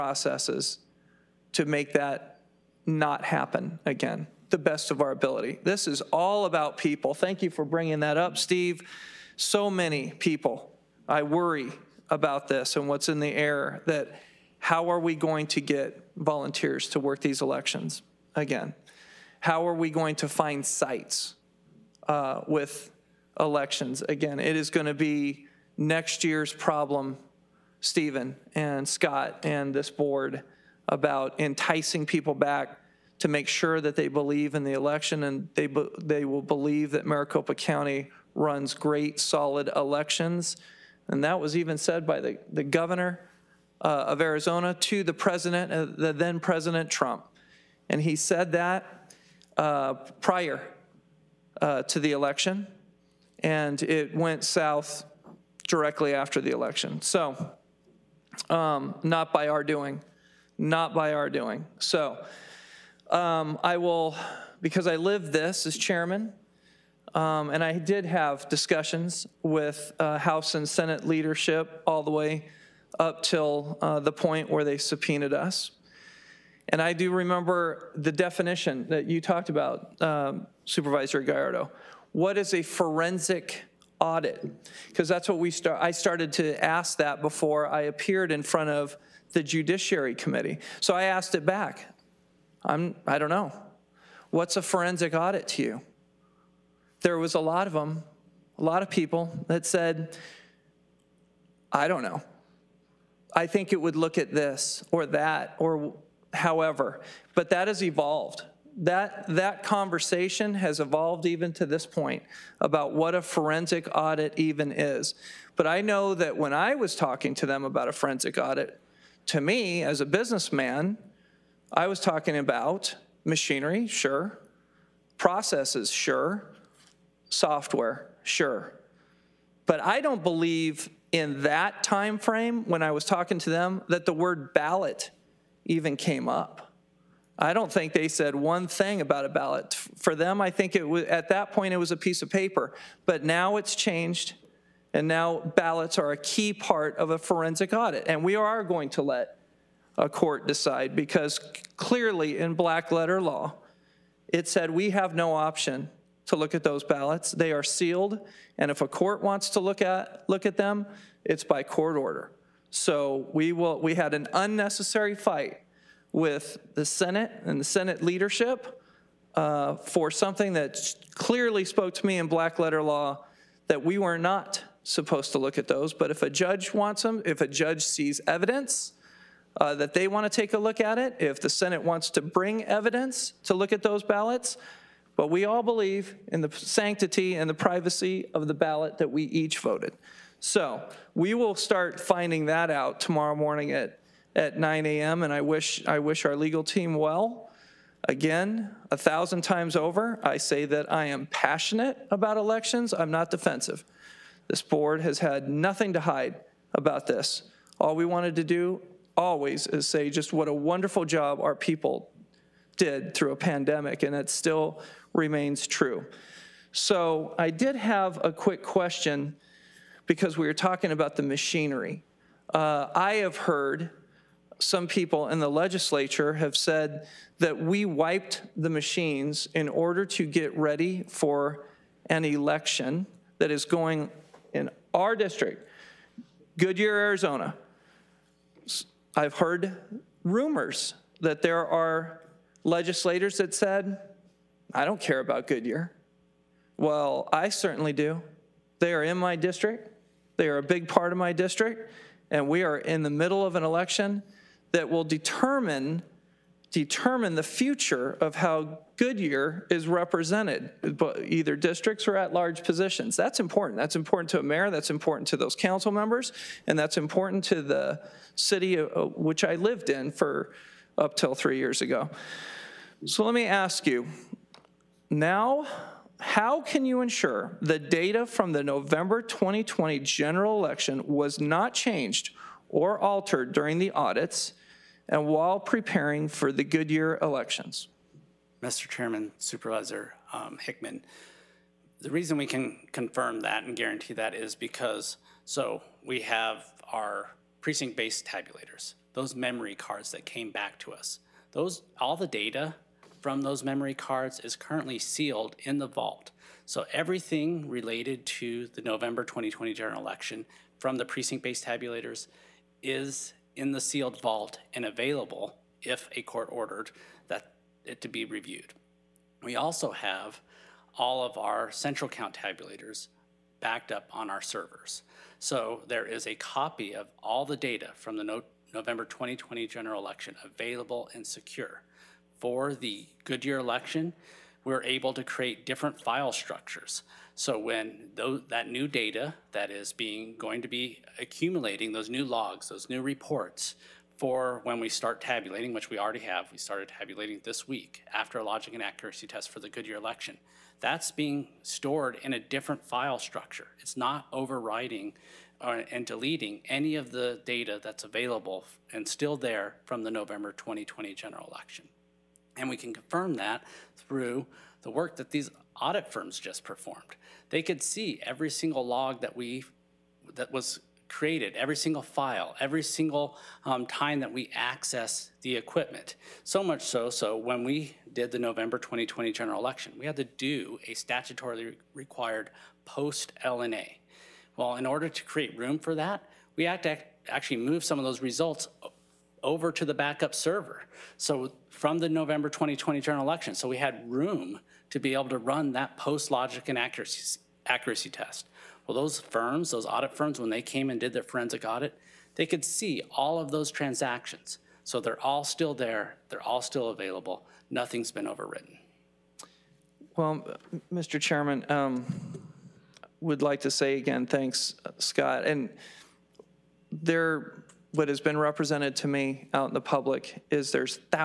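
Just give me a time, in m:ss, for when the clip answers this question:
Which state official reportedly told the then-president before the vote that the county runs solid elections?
0:42.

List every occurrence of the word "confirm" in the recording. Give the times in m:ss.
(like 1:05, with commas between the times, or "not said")
4:52, 6:02.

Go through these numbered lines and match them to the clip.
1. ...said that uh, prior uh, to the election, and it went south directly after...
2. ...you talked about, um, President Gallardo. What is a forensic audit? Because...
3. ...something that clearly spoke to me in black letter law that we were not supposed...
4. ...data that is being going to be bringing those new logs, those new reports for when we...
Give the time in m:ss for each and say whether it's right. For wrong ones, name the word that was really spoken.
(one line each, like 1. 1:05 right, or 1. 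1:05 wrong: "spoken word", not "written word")
1. 0:48 right
2. 1:19 wrong: "Supervisor", not "President"
3. 2:50 right
4. 5:38 wrong: "accumulating", not "bringing".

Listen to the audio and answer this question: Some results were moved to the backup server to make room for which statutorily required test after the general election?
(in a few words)
post L&A.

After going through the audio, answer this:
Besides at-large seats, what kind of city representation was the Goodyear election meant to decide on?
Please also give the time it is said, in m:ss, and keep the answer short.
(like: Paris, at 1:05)
districts, at 4:21.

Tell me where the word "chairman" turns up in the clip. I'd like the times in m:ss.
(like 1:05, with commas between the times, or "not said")
1:05, 4:48, 6:51.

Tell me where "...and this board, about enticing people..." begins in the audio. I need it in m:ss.
0:29.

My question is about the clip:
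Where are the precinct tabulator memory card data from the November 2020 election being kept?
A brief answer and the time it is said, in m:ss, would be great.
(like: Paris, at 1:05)
sealed vault, at 5:04.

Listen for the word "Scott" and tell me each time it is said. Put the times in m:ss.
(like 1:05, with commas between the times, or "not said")
0:28, 6:54.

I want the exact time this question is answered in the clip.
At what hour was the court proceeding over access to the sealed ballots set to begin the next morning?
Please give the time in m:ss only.
3:14.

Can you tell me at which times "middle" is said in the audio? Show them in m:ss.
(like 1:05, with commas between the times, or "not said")
4:13.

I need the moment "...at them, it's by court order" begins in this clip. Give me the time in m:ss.
2:40.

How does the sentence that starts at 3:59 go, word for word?
I've heard rumors that there are legislators that said, I don't care about Goodyear.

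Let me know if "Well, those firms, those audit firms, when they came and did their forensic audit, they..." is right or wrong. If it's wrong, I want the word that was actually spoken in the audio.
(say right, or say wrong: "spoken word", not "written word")
right.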